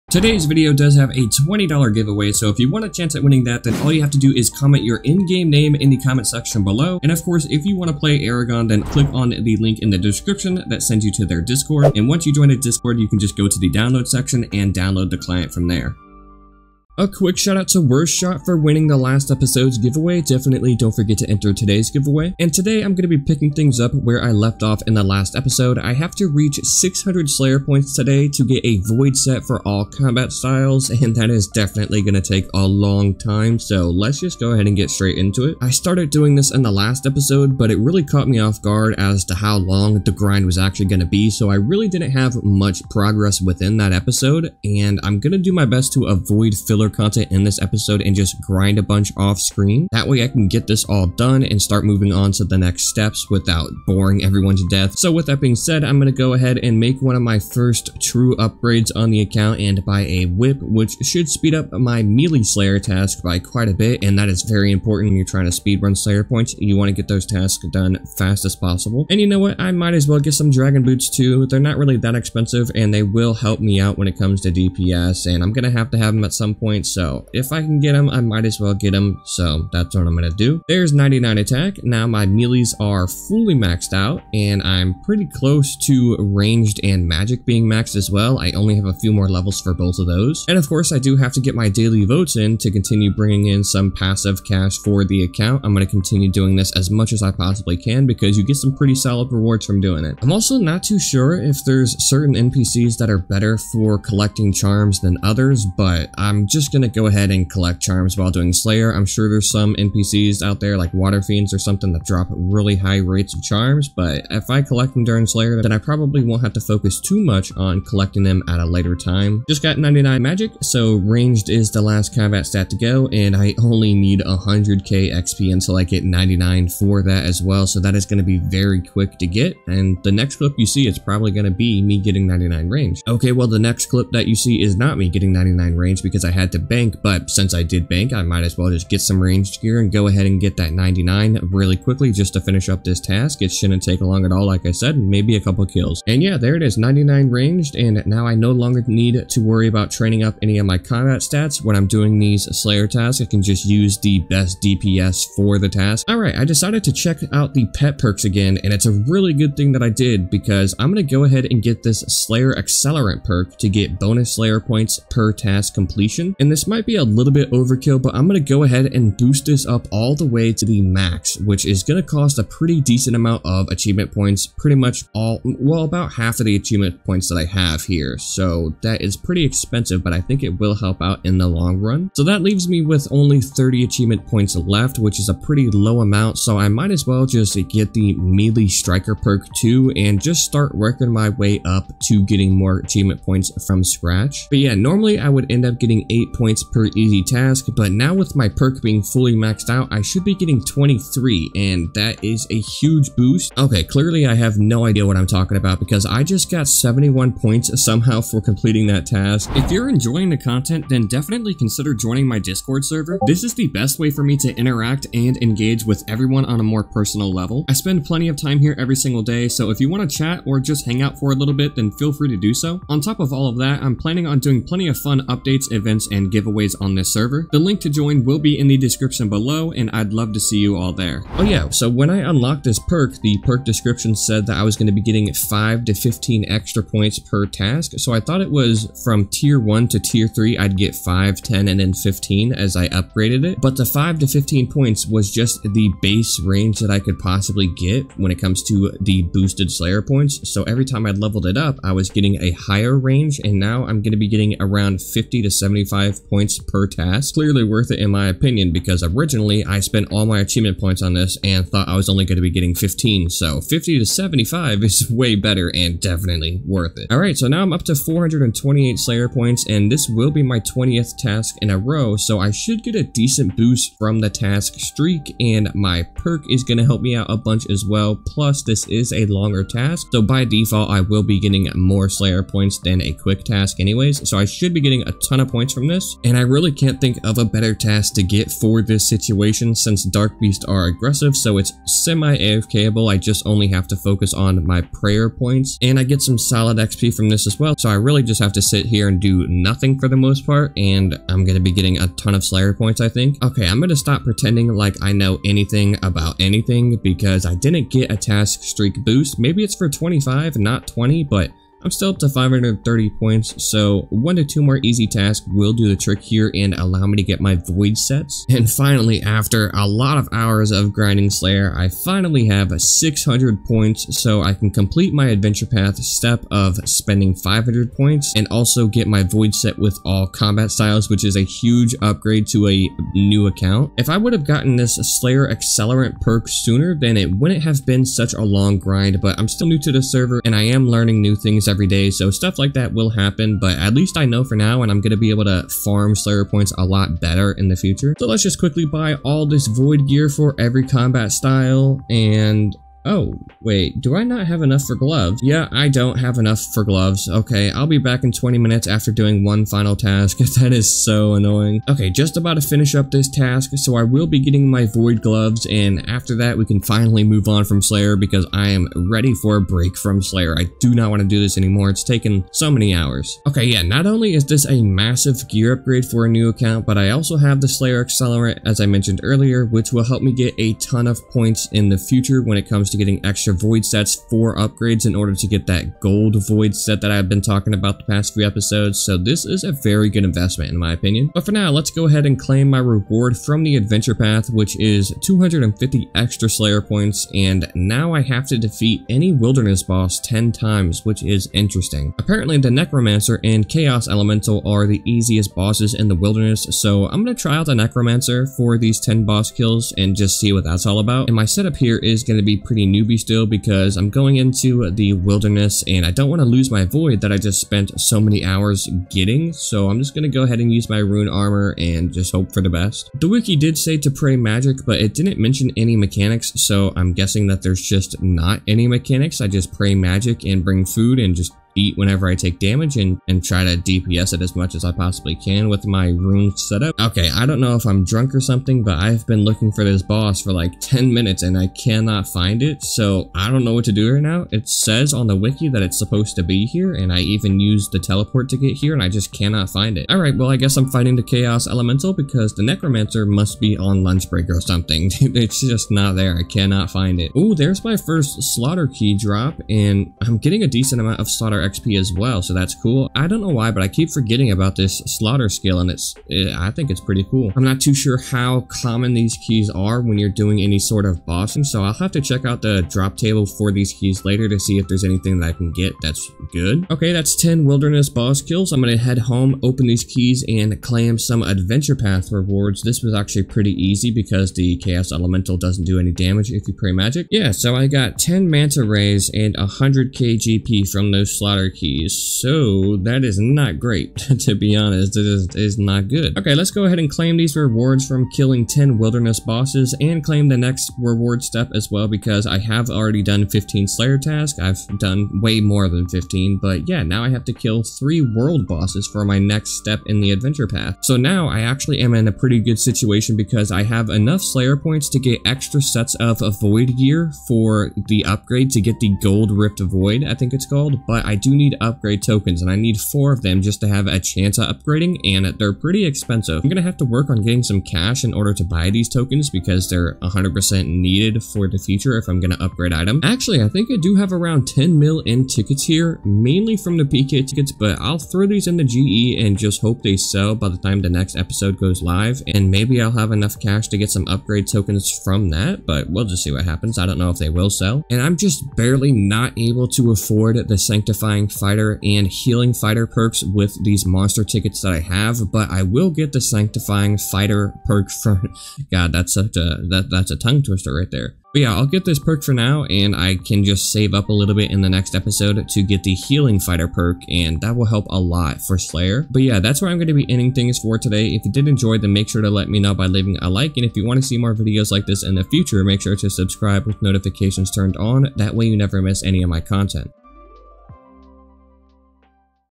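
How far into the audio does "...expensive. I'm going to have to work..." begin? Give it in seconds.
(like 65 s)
526 s.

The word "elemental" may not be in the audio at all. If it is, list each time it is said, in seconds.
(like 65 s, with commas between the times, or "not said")
404 s, 451 s, 485 s.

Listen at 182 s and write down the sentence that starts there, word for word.
So that leaves me with only 30 achievement points left, which is a pretty low amount.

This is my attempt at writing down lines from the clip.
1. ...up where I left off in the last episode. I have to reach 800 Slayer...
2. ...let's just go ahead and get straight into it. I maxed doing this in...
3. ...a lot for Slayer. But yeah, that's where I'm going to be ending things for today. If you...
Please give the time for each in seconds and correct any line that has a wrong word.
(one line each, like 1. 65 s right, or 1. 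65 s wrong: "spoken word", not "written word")
1. 23 s wrong: "600", not "800"
2. 33 s wrong: "started", not "maxed"
3. 568 s right.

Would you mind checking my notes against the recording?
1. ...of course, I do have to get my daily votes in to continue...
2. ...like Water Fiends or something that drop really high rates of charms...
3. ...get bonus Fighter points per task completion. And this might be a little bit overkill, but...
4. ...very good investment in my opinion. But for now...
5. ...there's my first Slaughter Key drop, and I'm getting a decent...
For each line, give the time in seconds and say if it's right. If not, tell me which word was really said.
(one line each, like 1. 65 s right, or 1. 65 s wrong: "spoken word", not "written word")
1. 90 s right
2. 110 s right
3. 163 s wrong: "Slayer", not "Fighter"
4. 389 s right
5. 457 s right.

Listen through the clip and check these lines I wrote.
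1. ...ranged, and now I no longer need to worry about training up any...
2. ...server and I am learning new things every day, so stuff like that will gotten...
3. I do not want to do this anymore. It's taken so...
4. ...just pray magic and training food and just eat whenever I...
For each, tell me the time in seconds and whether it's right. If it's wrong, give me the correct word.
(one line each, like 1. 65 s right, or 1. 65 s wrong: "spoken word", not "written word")
1. 147 s right
2. 340 s wrong: "happen", not "gotten"
3. 370 s right
4. 429 s wrong: "bring", not "training".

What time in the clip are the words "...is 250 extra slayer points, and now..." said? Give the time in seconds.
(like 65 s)
394 s.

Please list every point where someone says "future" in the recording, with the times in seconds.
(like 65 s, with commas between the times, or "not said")
347 s, 381 s, 531 s, 575 s.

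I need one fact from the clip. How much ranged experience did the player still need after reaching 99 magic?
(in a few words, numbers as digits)
100k XP.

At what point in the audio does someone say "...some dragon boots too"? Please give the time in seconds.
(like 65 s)
70 s.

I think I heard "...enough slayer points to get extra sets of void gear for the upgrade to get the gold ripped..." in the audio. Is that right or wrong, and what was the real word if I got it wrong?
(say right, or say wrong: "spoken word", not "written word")
right.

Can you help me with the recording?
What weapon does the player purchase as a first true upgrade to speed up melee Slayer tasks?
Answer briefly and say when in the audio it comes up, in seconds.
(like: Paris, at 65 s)
whip, at 60 s.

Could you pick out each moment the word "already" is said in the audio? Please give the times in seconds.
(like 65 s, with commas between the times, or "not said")
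502 s.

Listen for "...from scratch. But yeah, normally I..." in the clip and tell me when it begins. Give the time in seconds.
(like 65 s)
193 s.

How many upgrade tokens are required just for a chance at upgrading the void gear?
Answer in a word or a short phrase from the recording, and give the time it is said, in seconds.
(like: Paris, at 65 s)
4, at 522 s.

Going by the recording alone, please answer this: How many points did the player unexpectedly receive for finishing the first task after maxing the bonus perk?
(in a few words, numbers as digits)
71.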